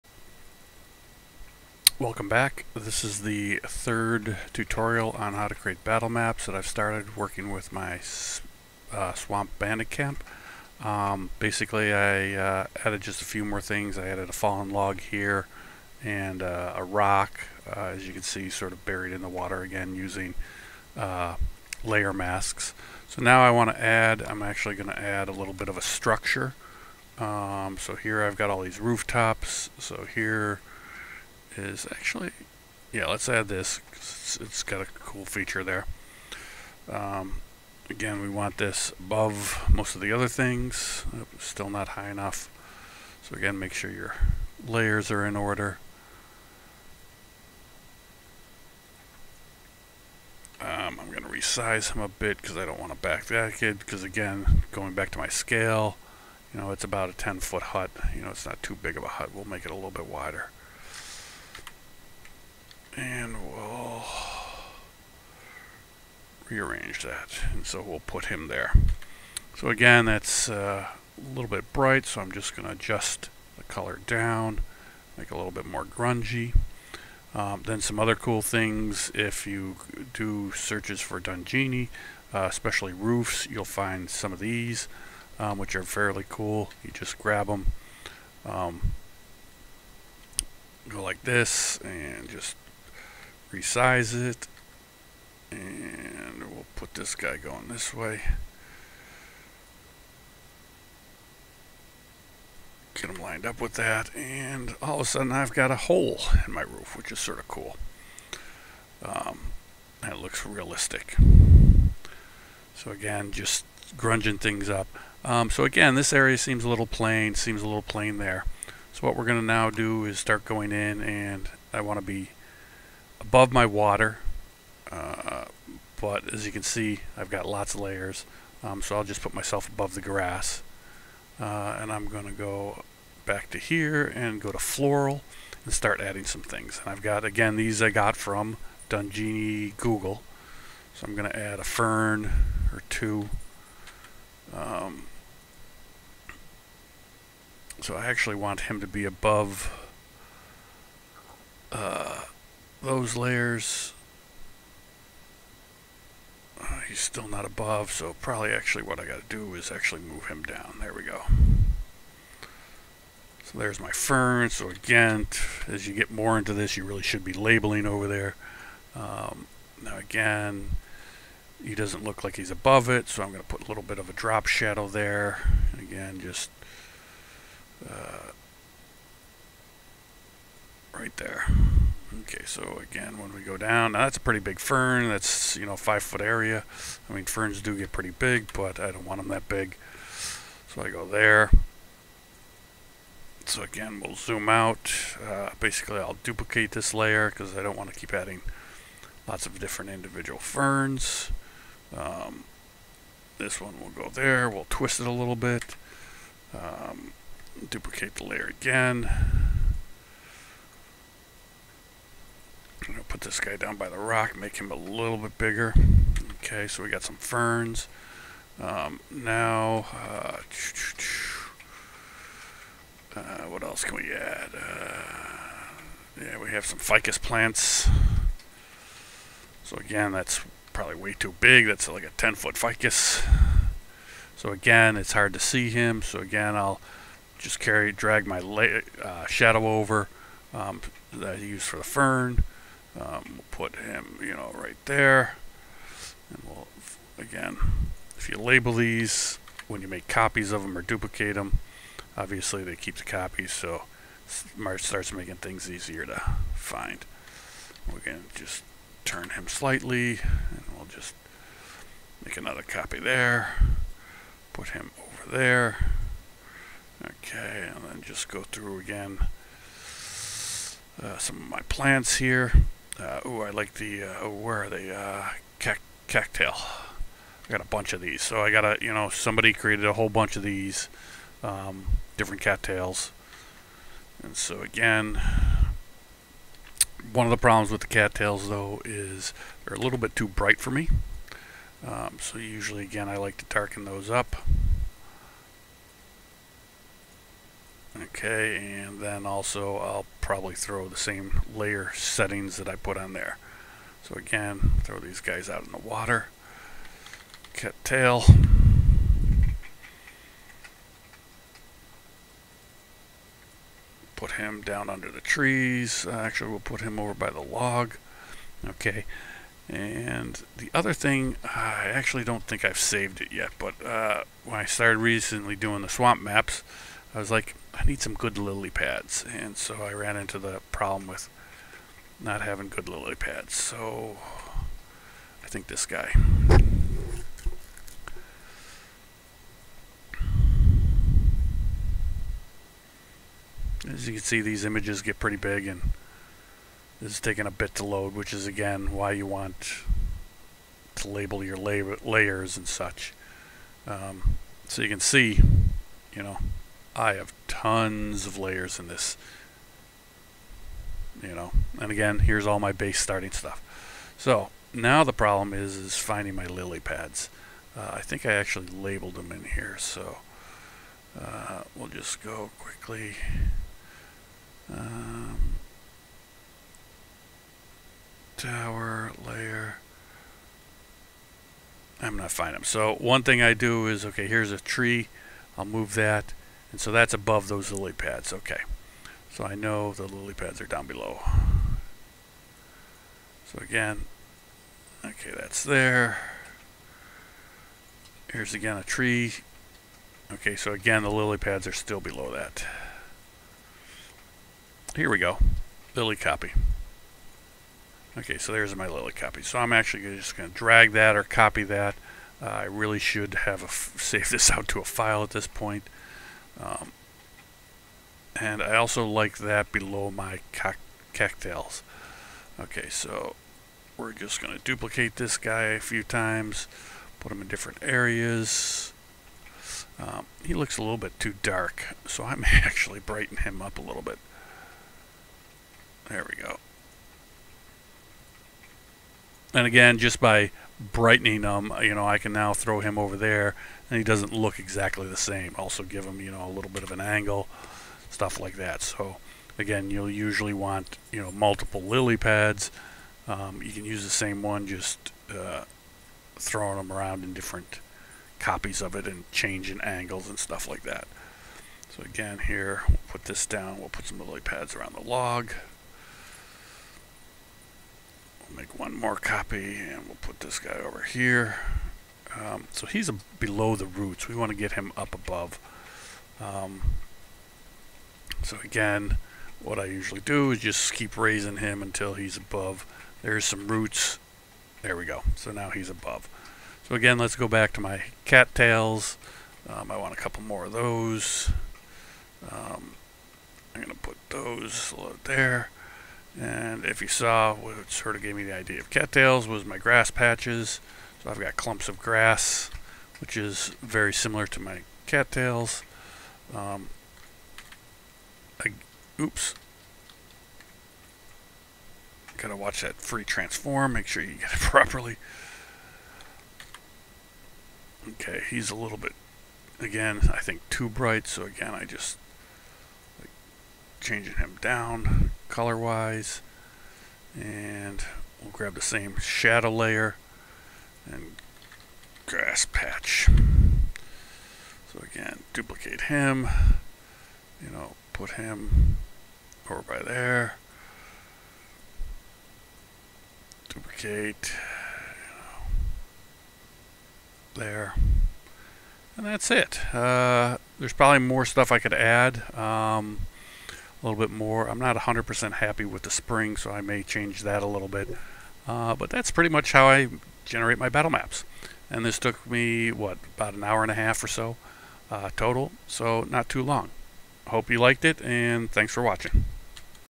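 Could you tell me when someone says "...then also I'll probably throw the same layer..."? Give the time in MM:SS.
04:59.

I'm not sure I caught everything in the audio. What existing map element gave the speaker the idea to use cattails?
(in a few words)
Grass patches.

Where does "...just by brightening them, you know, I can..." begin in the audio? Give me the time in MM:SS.
07:19.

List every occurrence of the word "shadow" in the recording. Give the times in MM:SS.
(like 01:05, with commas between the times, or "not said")
02:54, 03:59, 08:49.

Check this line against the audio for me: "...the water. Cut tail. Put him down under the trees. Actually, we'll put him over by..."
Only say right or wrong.
right.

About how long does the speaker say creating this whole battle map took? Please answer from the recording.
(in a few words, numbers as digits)
An hour and a half.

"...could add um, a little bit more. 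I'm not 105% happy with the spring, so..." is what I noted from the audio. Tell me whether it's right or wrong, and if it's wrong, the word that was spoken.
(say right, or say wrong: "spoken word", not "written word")
wrong: "100", not "105".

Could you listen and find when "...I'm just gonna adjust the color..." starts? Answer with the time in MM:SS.
01:12.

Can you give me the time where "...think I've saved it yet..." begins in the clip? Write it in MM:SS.
05:22.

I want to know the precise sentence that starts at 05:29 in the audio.
And so I ran into the problem with not having good lily pads.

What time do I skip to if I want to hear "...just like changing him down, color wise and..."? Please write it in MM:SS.
08:41.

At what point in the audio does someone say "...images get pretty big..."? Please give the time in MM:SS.
05:44.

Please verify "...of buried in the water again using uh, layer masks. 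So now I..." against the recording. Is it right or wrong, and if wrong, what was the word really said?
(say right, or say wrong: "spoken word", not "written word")
right.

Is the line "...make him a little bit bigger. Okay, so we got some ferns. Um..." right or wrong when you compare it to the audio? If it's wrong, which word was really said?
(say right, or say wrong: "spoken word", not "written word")
right.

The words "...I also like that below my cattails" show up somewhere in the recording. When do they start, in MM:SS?
06:58.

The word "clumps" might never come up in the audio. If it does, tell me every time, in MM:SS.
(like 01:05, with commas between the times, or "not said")
08:21.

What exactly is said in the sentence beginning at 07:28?
So again, you'll usually want, you know, multiple lily pads.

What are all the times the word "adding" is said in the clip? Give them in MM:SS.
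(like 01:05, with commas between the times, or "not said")
02:16, 03:18.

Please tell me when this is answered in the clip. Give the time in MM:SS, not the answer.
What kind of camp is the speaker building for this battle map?
00:09.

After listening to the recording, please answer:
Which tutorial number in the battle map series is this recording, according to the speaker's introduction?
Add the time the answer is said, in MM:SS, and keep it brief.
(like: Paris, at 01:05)
Third, at 00:03.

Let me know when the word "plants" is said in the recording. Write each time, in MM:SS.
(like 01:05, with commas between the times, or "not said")
03:47, 04:31.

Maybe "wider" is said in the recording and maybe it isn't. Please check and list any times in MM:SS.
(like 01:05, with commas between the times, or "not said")
01:00.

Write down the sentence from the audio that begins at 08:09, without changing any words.
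Um, I want a couple more of those.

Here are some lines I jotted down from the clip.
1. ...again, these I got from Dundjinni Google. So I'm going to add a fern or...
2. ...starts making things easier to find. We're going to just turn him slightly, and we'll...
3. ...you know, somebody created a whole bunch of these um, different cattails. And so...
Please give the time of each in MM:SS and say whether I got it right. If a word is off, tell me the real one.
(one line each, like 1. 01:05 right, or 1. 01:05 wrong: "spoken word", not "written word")
1. 02:17 right
2. 04:14 right
3. 04:38 right.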